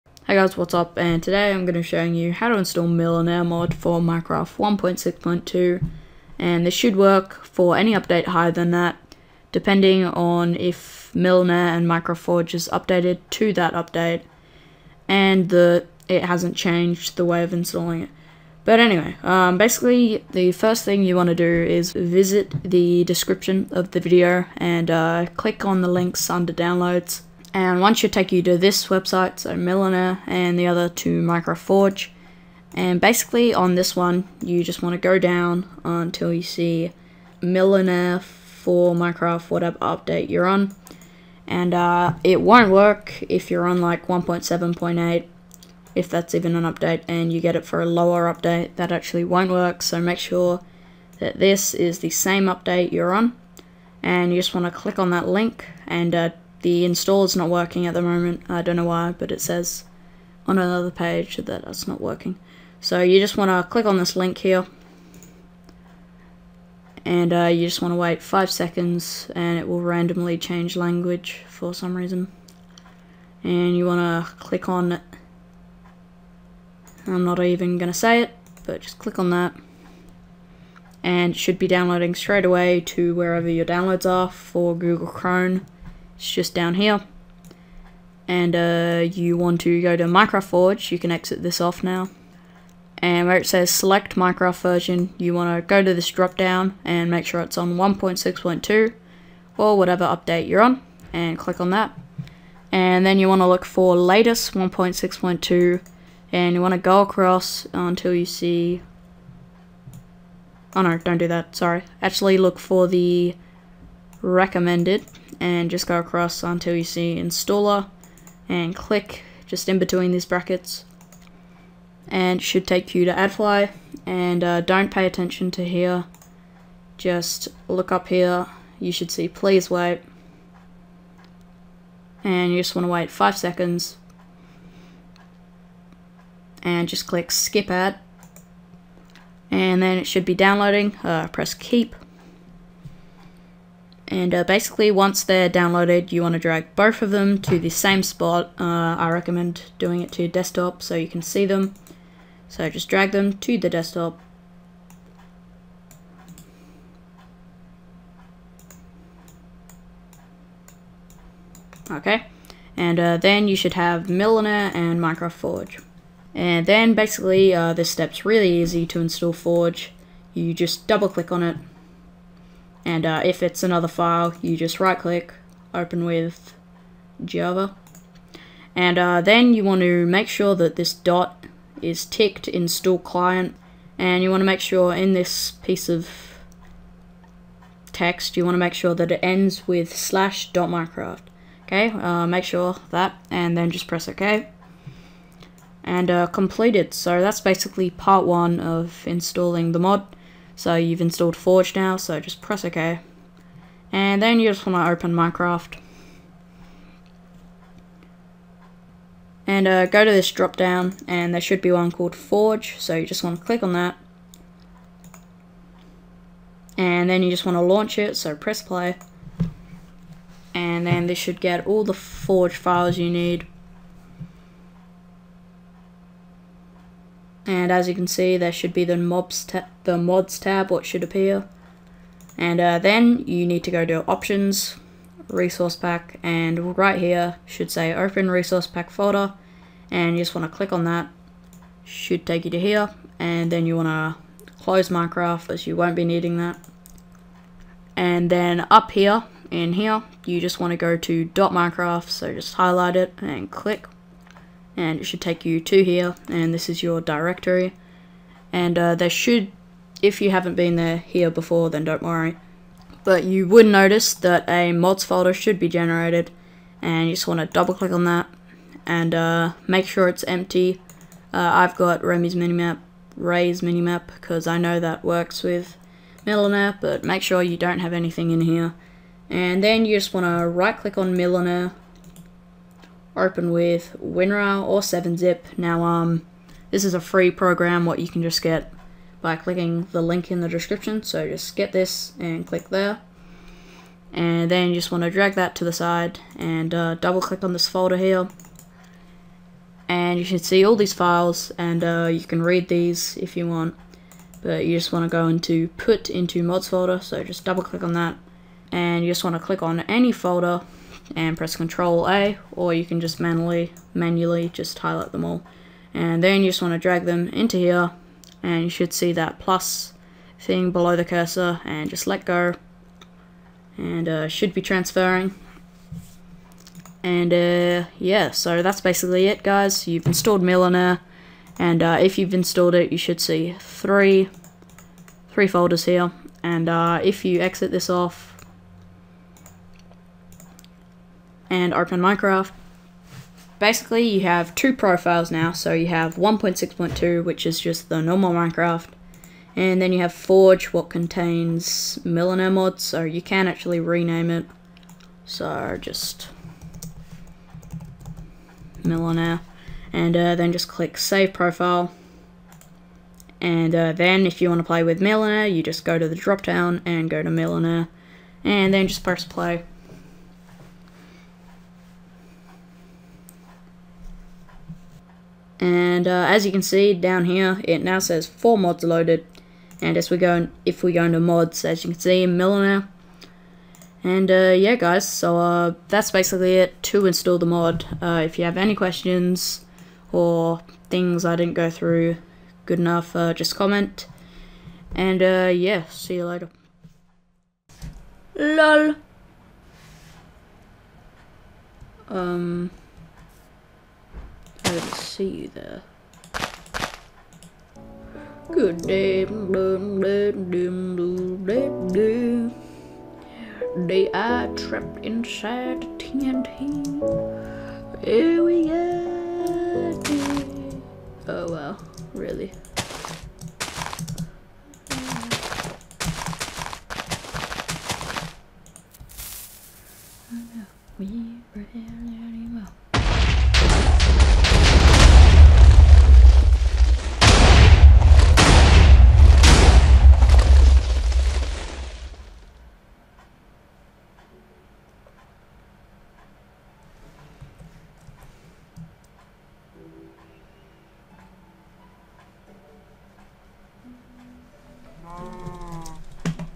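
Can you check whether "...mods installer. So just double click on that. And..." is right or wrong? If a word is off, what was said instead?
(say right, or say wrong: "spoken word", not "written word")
wrong: "folder", not "installer".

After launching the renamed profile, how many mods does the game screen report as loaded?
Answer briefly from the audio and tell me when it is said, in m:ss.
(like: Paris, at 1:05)
4, at 6:18.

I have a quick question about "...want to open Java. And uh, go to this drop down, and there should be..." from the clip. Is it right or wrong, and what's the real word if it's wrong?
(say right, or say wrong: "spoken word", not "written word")
wrong: "Minecraft", not "Java".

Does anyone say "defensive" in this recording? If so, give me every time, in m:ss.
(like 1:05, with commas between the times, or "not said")
not said.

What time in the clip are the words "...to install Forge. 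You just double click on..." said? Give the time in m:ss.
2:48.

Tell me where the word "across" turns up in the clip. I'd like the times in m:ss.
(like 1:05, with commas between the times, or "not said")
1:47, 1:55.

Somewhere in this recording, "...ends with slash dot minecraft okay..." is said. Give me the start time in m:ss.
3:09.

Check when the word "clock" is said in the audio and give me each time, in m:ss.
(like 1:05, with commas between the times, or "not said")
not said.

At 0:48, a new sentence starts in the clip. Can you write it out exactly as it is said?
That actually won't work, so make sure that this is the same update you're on.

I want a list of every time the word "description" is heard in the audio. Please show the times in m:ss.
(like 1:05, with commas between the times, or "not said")
0:23, 4:50.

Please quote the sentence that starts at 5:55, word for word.
So just Millenaire, and uh, then just click Save Profile.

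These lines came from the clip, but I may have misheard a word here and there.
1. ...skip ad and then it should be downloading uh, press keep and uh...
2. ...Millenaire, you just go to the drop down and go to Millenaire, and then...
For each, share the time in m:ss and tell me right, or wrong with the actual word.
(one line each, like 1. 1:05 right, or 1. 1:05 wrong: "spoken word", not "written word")
1. 2:17 right
2. 6:05 right.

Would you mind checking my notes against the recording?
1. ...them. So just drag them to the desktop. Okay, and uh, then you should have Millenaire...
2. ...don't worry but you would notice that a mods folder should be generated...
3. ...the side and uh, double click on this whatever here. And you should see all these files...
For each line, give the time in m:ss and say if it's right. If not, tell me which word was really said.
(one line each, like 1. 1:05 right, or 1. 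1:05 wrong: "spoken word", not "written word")
1. 2:31 right
2. 4:21 right
3. 4:55 wrong: "folder", not "whatever".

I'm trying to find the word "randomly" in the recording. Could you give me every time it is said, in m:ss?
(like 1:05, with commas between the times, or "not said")
1:09.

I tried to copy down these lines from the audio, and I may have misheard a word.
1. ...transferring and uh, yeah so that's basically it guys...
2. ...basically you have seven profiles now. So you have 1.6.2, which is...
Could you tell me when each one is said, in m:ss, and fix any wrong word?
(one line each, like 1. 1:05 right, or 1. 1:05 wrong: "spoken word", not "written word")
1. 5:24 right
2. 5:43 wrong: "two", not "seven".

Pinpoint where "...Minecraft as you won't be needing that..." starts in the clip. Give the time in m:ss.
4:04.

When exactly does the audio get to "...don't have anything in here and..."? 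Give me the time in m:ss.
4:37.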